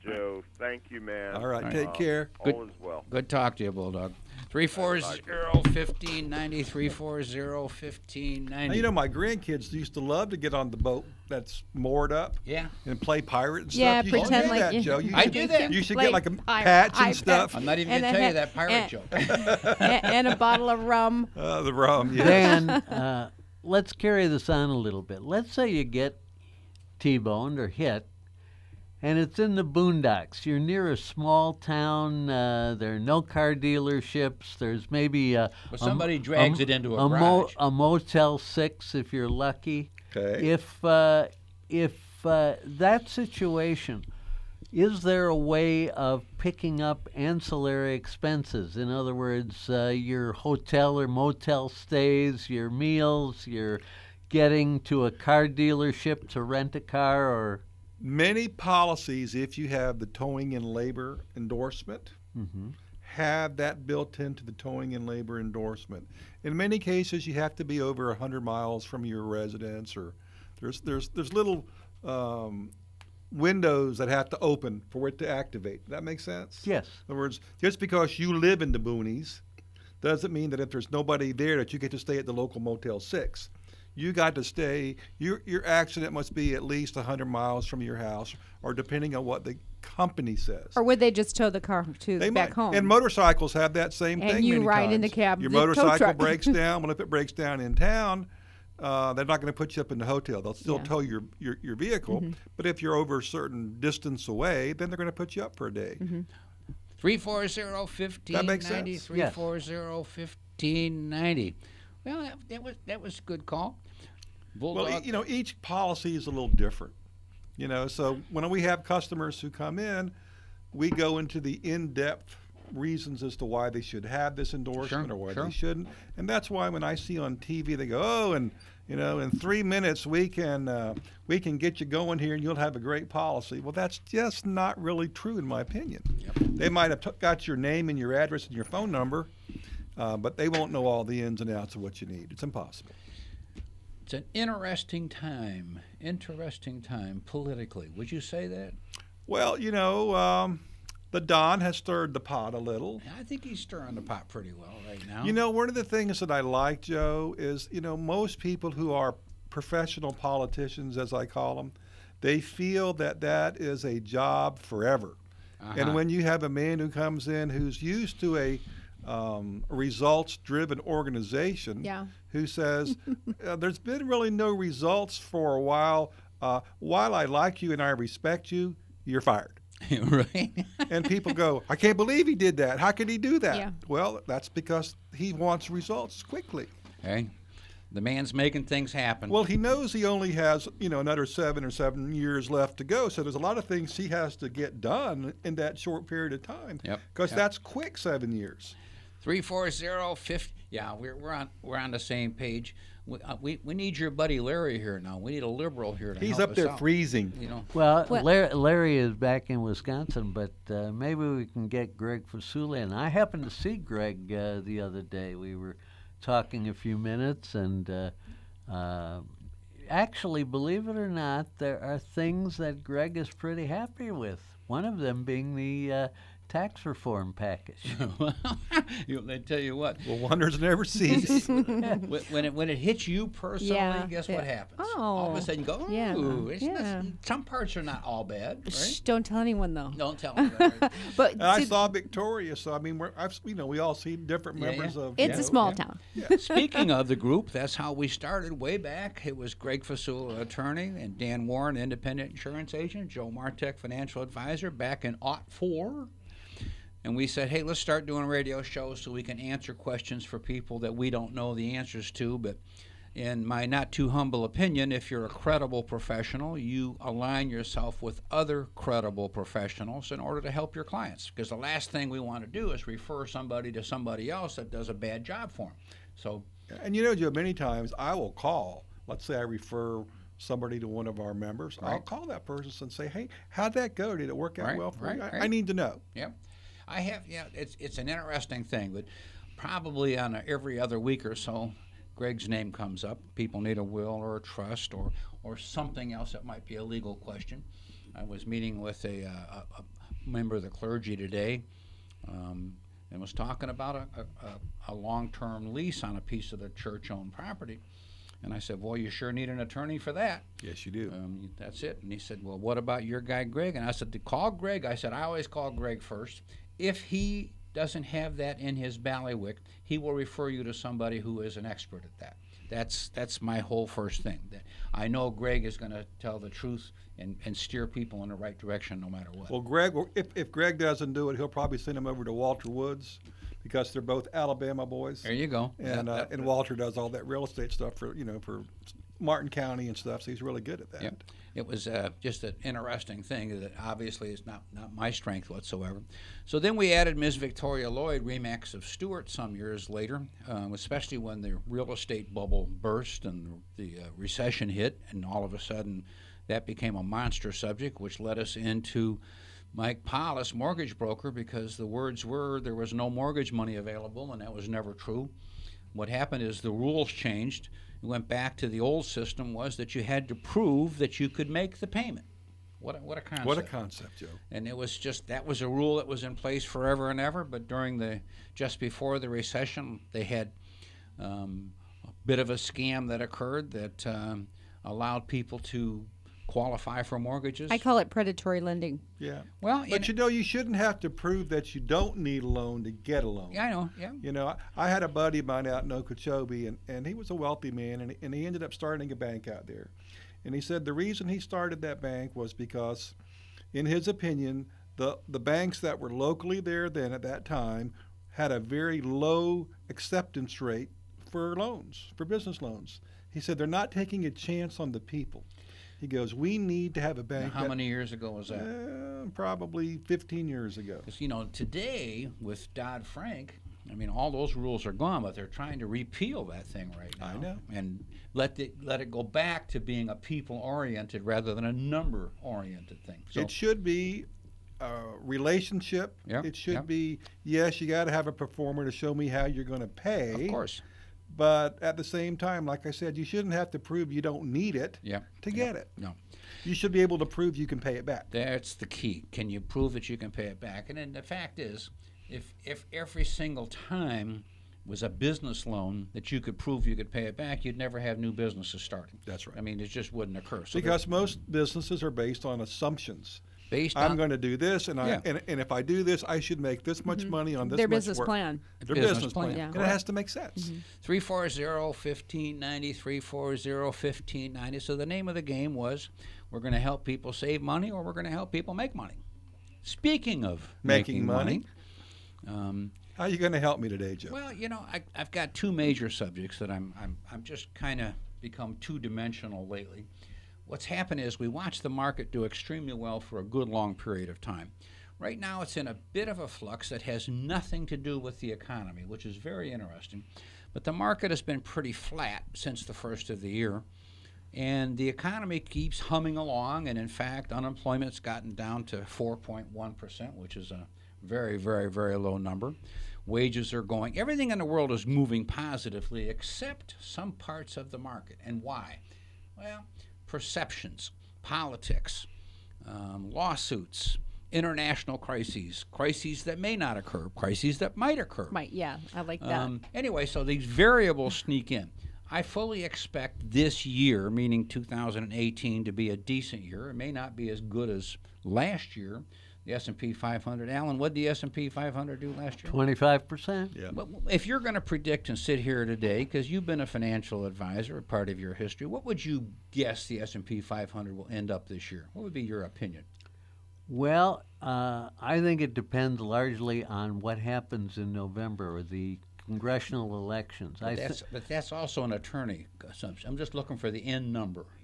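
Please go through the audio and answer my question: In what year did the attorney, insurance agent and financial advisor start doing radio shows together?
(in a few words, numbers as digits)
2004.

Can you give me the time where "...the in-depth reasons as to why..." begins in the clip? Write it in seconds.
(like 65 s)
121 s.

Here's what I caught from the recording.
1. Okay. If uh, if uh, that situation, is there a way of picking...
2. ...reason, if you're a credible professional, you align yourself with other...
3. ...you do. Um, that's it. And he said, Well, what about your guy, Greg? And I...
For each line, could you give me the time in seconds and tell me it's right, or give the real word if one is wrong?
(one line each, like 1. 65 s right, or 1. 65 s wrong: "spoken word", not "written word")
1. 40 s right
2. 264 s wrong: "opinion", not "reason"
3. 310 s right.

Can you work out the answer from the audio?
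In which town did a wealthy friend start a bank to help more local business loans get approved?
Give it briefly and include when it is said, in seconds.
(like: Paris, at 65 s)
Okeechobee, at 395 s.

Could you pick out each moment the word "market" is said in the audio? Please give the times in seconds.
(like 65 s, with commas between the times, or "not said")
491 s, 500 s, 517 s.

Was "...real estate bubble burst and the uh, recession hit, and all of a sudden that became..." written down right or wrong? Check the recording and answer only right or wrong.
right.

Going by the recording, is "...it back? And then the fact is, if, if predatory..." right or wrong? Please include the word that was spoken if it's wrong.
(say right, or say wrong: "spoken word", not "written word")
wrong: "every", not "predatory".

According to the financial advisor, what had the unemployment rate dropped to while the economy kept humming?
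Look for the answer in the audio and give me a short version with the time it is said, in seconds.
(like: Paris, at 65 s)
4.1%, at 509 s.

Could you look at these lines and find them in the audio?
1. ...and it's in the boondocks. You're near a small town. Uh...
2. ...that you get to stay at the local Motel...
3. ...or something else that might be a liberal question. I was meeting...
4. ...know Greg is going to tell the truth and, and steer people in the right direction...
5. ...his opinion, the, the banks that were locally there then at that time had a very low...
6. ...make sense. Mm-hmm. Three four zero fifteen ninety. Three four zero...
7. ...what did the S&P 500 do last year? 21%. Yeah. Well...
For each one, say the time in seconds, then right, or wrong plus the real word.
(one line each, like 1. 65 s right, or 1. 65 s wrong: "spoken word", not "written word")
1. 29 s right
2. 81 s right
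3. 295 s wrong: "legal", not "liberal"
4. 325 s right
5. 403 s right
6. 470 s right
7. 540 s wrong: "25", not "21".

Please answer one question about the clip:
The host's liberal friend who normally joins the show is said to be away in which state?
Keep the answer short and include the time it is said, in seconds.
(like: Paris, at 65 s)
Wisconsin, at 209 s.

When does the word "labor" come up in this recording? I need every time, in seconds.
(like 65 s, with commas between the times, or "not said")
60 s, 65 s.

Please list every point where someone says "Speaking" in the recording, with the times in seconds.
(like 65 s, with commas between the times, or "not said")
246 s, 479 s.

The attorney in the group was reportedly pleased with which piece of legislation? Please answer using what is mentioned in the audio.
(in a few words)
tax reform package.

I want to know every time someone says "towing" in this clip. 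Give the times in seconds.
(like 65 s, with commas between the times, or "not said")
60 s, 64 s.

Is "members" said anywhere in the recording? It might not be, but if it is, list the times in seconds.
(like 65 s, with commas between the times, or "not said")
244 s, 281 s, 300 s.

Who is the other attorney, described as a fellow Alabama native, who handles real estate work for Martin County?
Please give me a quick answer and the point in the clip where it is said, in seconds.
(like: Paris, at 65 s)
Walter Woods, at 332 s.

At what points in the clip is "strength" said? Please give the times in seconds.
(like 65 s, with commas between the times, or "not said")
345 s.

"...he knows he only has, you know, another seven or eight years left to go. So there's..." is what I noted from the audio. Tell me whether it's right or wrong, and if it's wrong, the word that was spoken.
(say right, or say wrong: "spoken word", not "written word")
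wrong: "seven", not "eight".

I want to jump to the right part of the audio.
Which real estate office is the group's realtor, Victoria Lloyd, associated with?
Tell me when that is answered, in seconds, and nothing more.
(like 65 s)
348 s.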